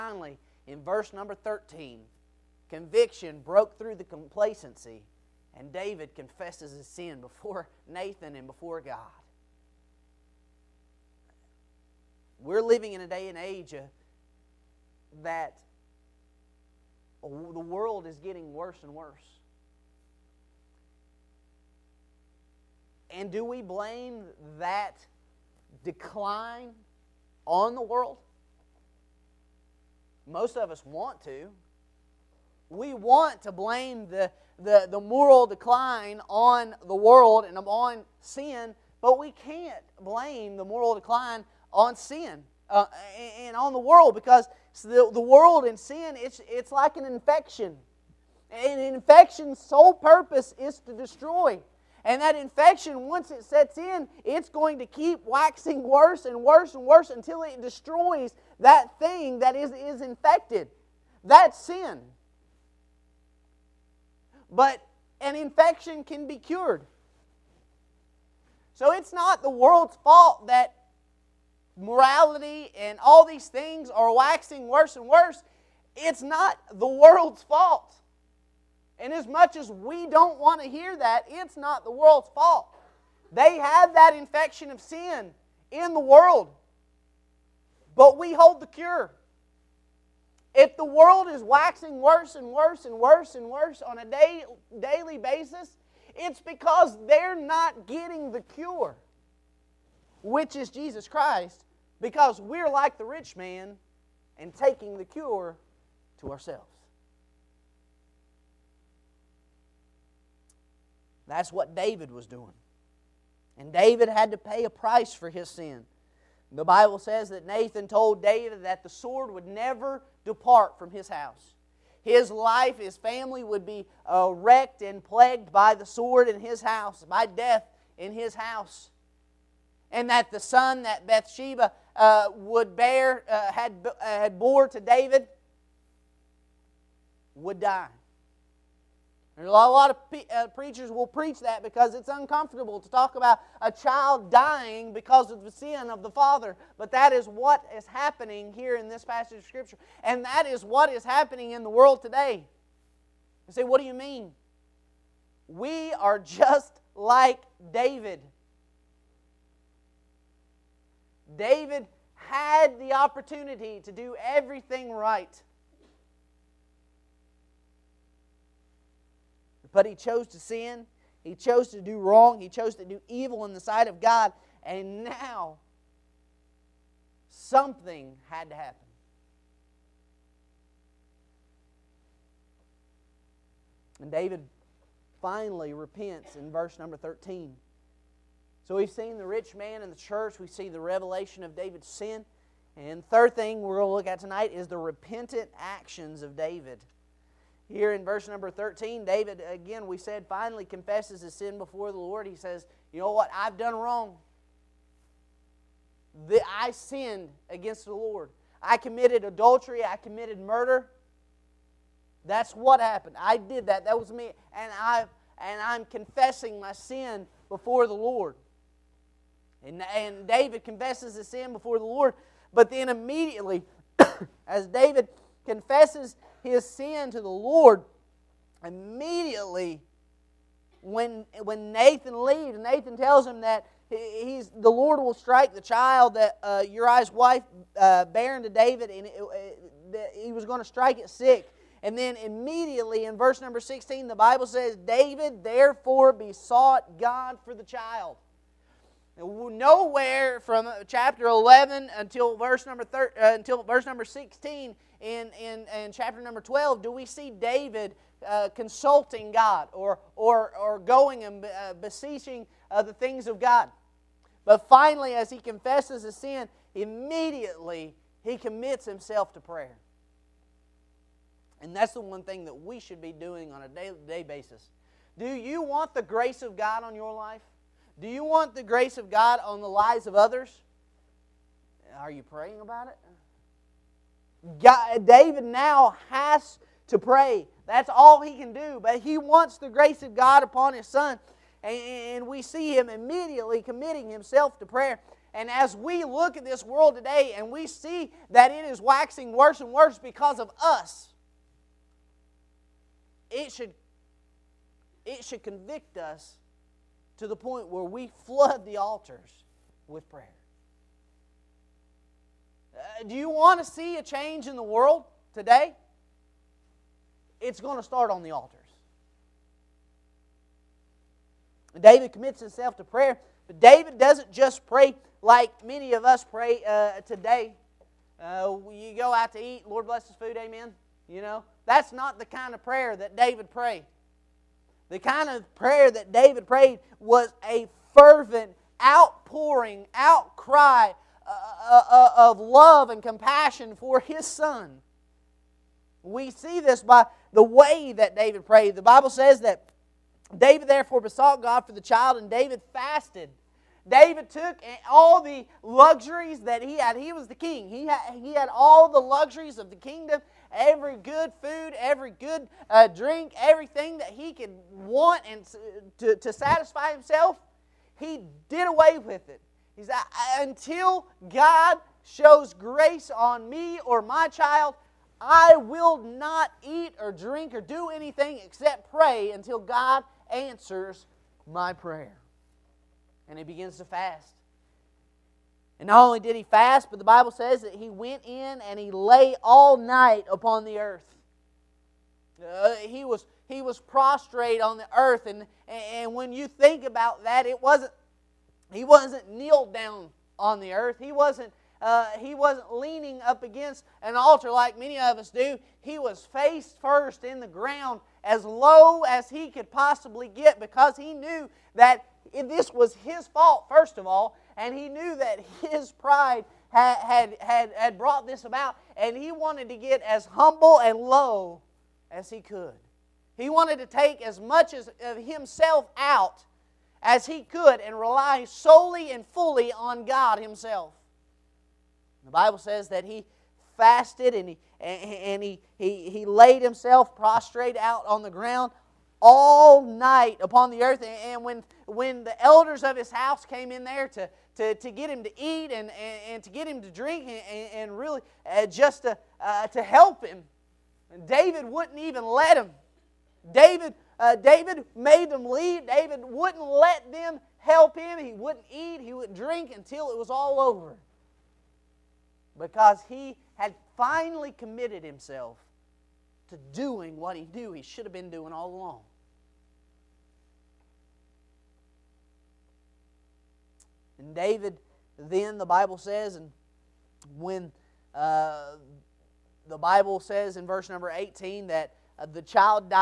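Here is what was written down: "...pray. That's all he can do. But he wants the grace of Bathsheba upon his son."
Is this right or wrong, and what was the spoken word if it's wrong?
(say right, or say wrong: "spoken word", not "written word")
wrong: "God", not "Bathsheba".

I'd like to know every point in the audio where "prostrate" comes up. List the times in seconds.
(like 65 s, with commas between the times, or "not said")
393 s, 437 s.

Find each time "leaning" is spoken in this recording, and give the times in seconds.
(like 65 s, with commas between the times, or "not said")
402 s.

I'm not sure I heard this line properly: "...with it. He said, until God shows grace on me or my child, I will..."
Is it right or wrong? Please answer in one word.
right.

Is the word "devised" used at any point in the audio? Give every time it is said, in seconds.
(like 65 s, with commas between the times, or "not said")
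not said.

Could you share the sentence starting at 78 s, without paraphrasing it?
And as much as we don't want to hear that, it's not the world's fault.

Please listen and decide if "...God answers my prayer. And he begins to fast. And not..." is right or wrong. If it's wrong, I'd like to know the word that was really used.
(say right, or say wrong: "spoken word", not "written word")
right.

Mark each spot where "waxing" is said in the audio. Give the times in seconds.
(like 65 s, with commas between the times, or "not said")
55 s, 74 s, 91 s, 298 s.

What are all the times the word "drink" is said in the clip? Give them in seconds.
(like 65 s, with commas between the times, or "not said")
362 s, 377 s, 446 s, 459 s.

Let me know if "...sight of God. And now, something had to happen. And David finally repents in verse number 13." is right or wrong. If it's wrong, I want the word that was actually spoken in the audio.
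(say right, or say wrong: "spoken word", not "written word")
right.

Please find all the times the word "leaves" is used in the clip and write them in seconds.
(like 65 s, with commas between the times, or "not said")
232 s, 455 s.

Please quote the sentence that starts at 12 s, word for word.
We're living in a day and age uh, that the world is getting worse and worse.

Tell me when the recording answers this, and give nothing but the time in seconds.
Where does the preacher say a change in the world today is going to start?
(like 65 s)
318 s.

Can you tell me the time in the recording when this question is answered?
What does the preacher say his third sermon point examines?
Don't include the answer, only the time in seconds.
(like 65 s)
194 s.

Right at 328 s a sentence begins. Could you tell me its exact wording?
Uh, you go out to eat, Lord bless his food, amen.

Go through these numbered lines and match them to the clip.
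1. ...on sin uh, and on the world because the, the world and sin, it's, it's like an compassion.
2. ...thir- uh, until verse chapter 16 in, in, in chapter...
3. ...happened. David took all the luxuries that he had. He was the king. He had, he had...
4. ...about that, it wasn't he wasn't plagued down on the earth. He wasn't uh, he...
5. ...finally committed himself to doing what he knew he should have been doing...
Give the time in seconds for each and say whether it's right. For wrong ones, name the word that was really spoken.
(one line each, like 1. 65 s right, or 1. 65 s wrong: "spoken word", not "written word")
1. 41 s wrong: "infection", not "compassion"
2. 252 s wrong: "number", not "chapter"
3. 352 s wrong: "fasted", not "happened"
4. 396 s wrong: "kneeled", not "plagued"
5. 463 s right.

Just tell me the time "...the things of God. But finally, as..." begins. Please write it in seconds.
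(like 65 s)
262 s.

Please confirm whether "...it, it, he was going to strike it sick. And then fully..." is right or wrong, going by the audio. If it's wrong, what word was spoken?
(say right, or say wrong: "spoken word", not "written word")
wrong: "immediately", not "fully".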